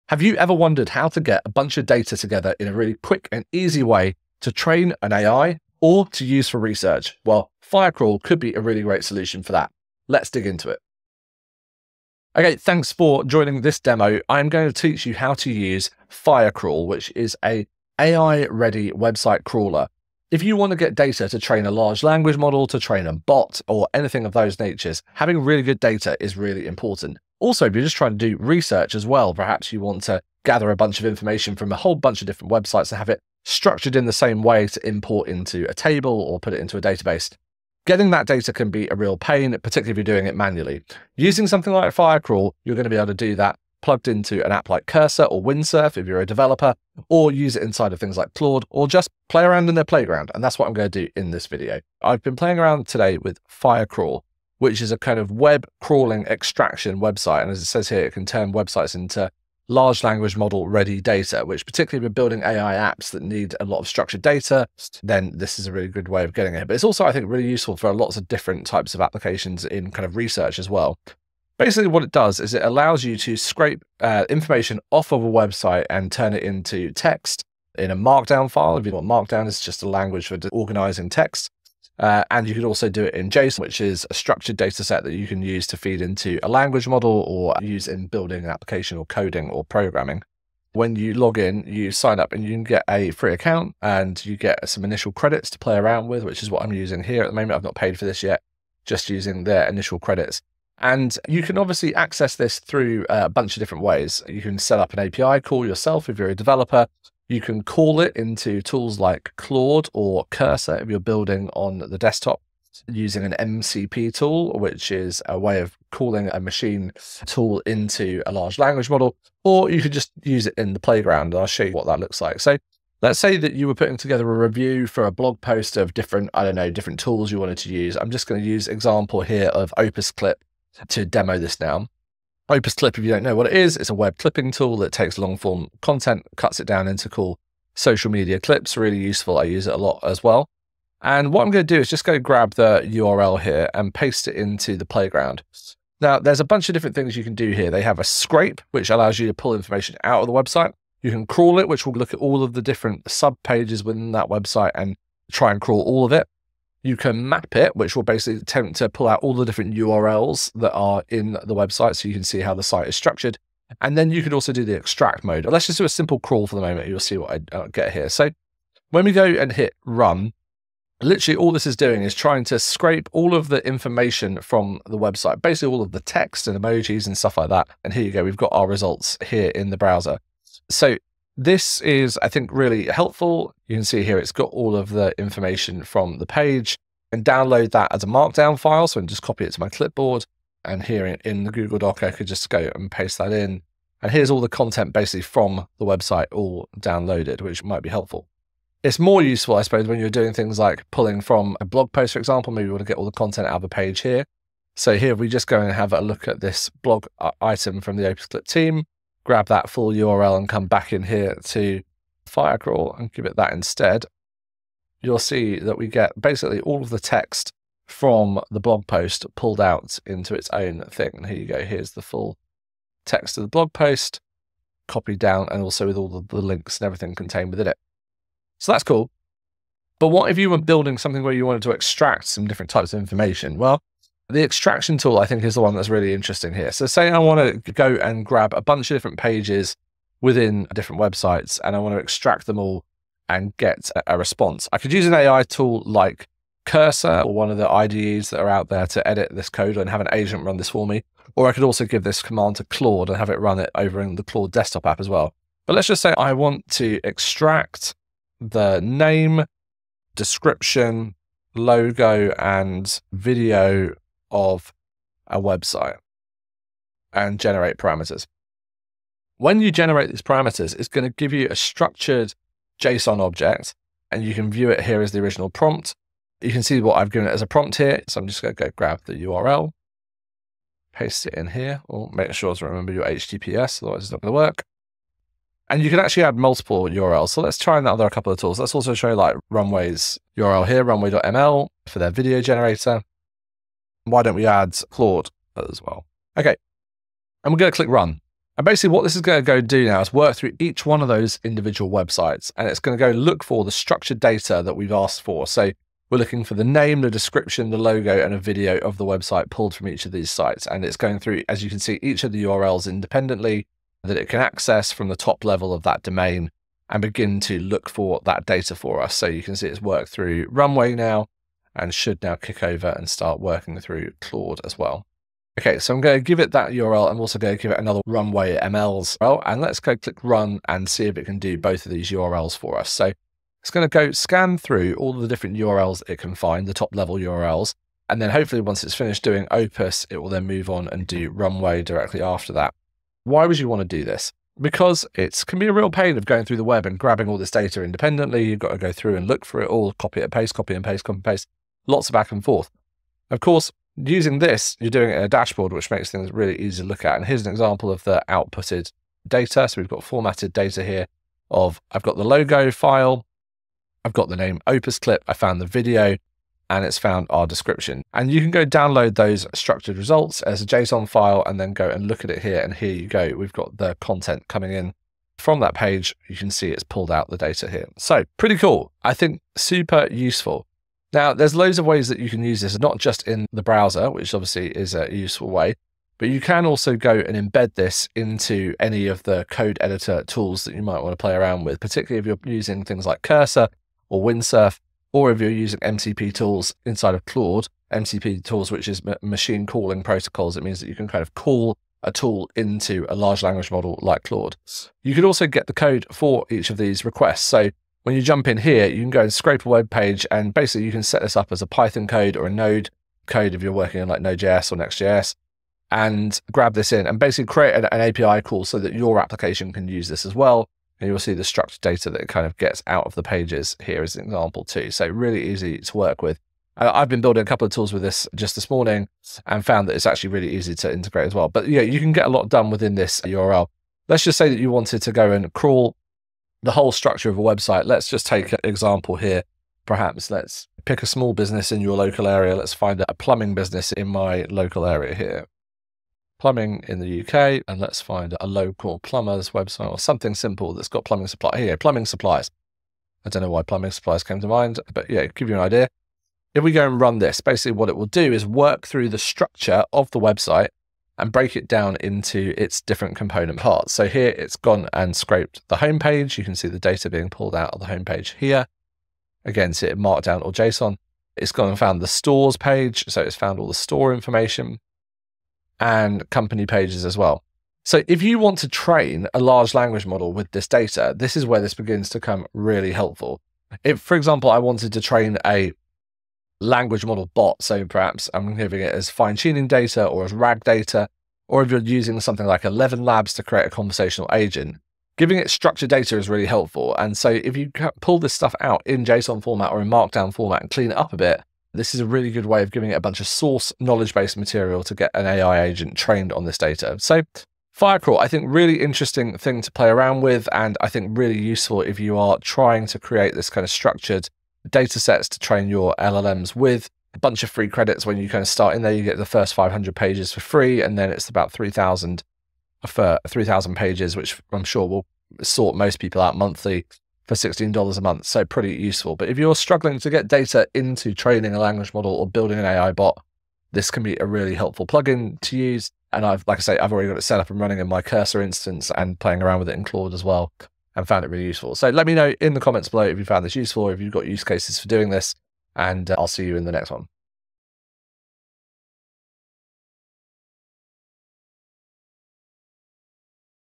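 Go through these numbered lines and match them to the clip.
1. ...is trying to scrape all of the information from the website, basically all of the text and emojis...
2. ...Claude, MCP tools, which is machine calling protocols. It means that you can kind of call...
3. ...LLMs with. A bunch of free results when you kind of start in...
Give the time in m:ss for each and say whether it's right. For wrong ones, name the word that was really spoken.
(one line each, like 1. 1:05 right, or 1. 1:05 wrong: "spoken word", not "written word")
1. 2:52 right
2. 6:37 right
3. 8:35 wrong: "credits", not "results".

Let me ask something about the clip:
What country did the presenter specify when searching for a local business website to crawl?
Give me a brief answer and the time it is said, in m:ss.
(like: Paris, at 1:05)
UK, at 7:27.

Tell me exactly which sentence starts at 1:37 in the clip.
I've not paid for this yet, just using their initial credits.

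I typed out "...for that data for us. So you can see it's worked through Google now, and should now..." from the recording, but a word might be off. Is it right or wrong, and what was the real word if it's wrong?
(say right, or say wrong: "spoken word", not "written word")
wrong: "Runway", not "Google".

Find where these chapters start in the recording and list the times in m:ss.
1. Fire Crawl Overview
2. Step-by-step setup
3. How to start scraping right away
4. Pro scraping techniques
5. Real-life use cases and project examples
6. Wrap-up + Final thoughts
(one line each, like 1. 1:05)
1. 0:12
2. 1:30
3. 2:02
4. 3:49
5. 5:43
6. 8:26.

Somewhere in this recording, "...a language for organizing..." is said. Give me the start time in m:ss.
1:19.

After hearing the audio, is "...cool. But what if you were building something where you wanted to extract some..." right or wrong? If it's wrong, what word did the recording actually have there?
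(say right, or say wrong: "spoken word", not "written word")
right.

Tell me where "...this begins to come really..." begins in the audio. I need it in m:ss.
8:01.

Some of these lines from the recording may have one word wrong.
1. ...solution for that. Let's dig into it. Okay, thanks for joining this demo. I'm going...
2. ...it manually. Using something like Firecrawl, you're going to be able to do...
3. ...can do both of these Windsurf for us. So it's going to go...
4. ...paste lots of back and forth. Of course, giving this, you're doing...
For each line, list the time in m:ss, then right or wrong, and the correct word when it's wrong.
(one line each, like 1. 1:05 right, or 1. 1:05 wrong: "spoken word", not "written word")
1. 0:09 right
2. 0:40 right
3. 5:31 wrong: "URLs", not "Windsurf"
4. 5:51 wrong: "using", not "giving".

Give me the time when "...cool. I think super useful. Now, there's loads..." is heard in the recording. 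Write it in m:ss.
6:18.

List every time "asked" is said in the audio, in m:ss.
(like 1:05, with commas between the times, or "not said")
5:04.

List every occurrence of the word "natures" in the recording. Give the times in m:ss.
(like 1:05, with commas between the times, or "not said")
0:24.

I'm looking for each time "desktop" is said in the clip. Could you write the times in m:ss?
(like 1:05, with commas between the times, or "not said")
1:51, 4:14.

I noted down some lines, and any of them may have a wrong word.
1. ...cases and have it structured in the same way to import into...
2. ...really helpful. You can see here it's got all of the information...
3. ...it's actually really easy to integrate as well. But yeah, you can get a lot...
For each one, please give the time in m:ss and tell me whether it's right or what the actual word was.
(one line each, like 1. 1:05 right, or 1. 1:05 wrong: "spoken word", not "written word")
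1. 0:32 wrong: "websites", not "cases"
2. 3:02 right
3. 7:09 right.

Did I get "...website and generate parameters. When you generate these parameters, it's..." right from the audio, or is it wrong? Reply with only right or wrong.
right.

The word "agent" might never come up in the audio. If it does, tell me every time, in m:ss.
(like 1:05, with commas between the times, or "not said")
4:10, 8:14, 8:25.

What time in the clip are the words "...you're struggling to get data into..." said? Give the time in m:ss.
8:49.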